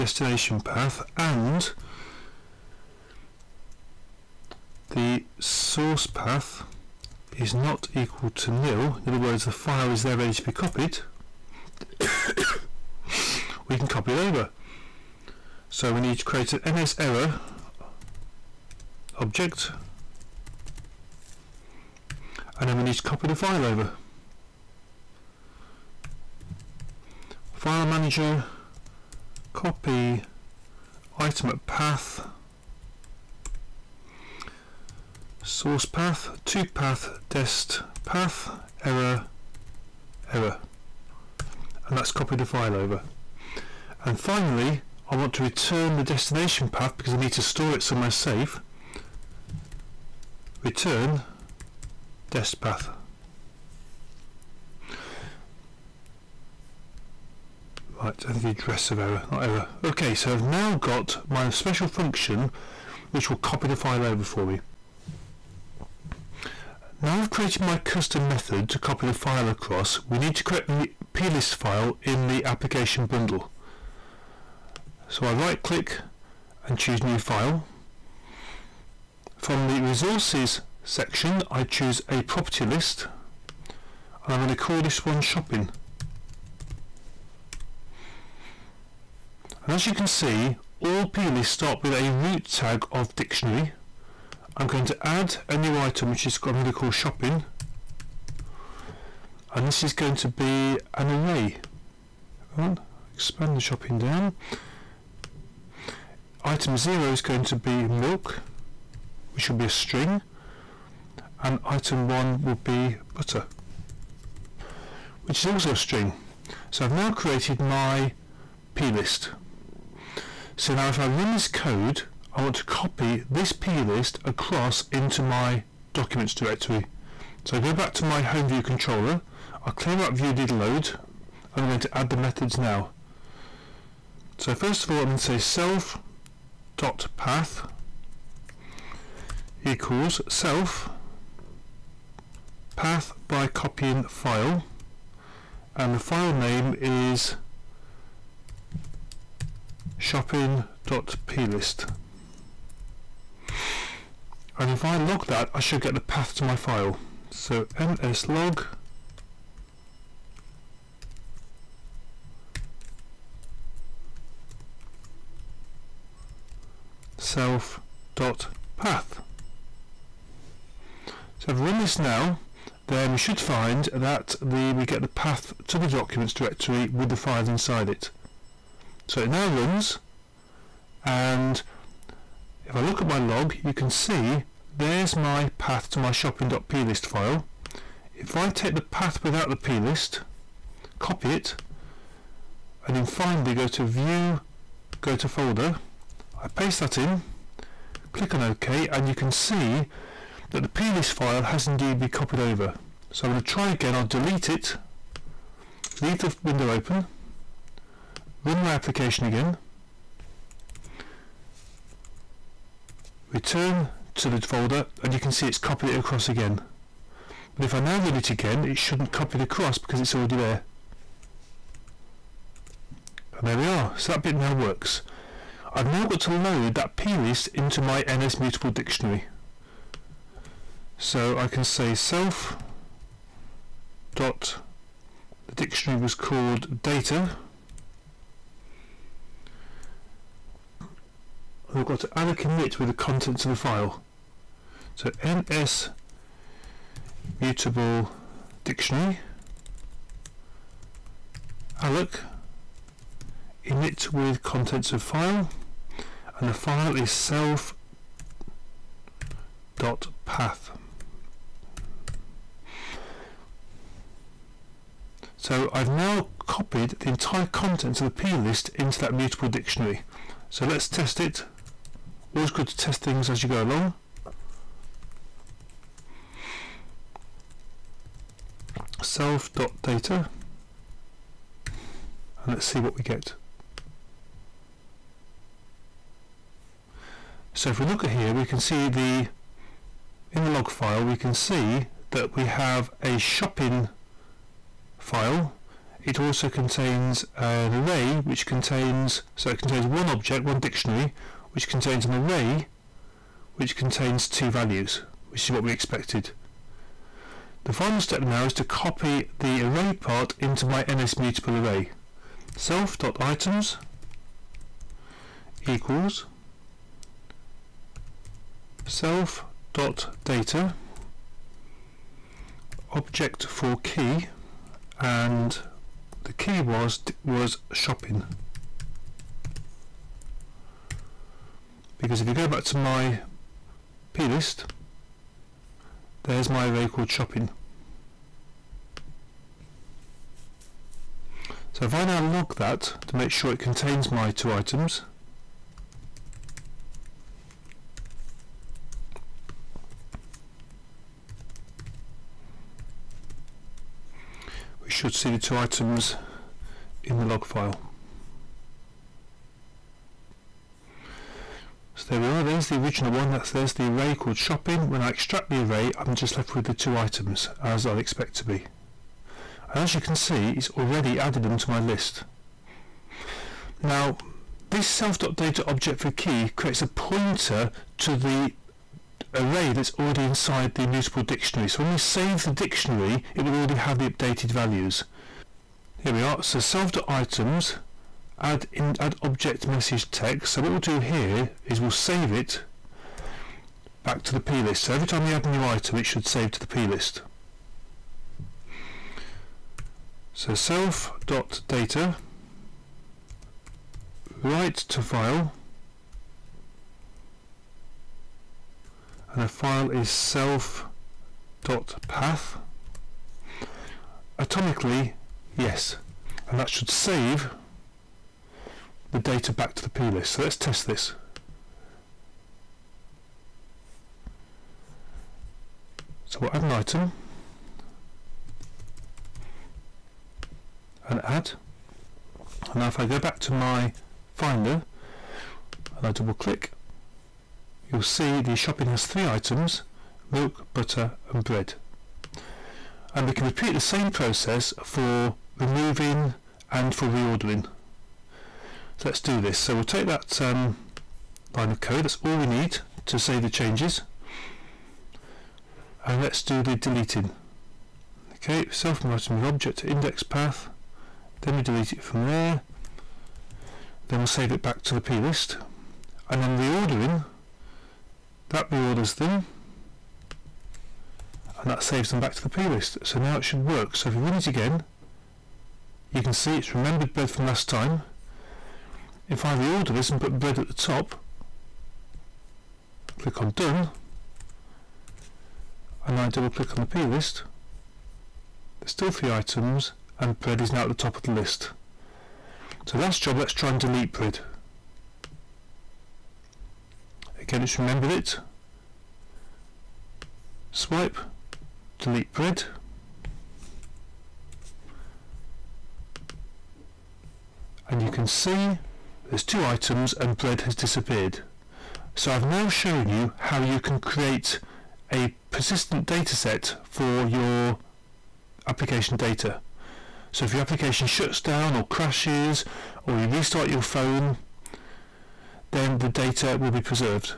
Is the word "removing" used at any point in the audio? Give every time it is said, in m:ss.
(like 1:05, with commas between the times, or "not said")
7:25.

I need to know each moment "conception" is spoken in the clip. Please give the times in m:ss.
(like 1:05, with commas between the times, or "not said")
not said.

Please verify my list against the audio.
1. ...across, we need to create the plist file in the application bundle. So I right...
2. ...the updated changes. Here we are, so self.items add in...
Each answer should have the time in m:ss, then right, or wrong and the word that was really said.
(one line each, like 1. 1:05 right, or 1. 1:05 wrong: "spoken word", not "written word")
1. 1:09 right
2. 6:23 wrong: "values", not "changes".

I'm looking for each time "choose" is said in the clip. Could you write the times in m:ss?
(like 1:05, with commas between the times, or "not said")
1:16, 1:21.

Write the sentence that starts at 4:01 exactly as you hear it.
I've got to allocate it with the contents of the file.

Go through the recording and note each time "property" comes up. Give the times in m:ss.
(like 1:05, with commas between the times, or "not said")
1:22.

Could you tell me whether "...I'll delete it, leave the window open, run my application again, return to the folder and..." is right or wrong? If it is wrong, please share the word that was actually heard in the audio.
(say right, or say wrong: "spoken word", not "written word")
right.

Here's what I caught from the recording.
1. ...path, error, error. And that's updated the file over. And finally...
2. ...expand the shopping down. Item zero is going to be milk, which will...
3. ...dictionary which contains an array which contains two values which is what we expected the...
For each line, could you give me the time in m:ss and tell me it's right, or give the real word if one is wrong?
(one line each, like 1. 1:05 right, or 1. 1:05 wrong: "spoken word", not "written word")
1. 0:38 wrong: "copied", not "updated"
2. 1:43 right
3. 5:00 right.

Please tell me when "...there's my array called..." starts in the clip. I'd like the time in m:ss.
5:36.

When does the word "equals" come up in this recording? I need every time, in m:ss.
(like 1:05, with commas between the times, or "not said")
0:07, 2:19, 5:15.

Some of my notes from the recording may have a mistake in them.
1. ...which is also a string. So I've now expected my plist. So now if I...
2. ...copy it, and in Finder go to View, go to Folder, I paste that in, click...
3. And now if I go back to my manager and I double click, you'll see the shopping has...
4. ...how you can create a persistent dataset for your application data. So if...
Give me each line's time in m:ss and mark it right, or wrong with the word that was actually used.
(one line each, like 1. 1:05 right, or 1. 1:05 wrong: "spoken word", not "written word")
1. 1:55 wrong: "created", not "expected"
2. 3:10 right
3. 7:12 wrong: "finder", not "manager"
4. 8:33 right.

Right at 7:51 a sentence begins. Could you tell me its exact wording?
And that saves them back to the plist.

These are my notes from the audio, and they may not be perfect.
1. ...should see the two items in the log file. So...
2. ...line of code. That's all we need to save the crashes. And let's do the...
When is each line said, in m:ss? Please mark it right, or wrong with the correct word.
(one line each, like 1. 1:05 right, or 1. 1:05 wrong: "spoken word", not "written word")
1. 5:54 right
2. 7:31 wrong: "changes", not "crashes".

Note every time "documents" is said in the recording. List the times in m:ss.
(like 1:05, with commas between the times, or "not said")
2:05, 2:55.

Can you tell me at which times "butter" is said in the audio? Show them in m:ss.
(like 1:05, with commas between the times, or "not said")
1:53, 7:20.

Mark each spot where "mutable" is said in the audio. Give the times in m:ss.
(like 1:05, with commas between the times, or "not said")
3:48, 4:07, 4:29, 5:11, 6:20.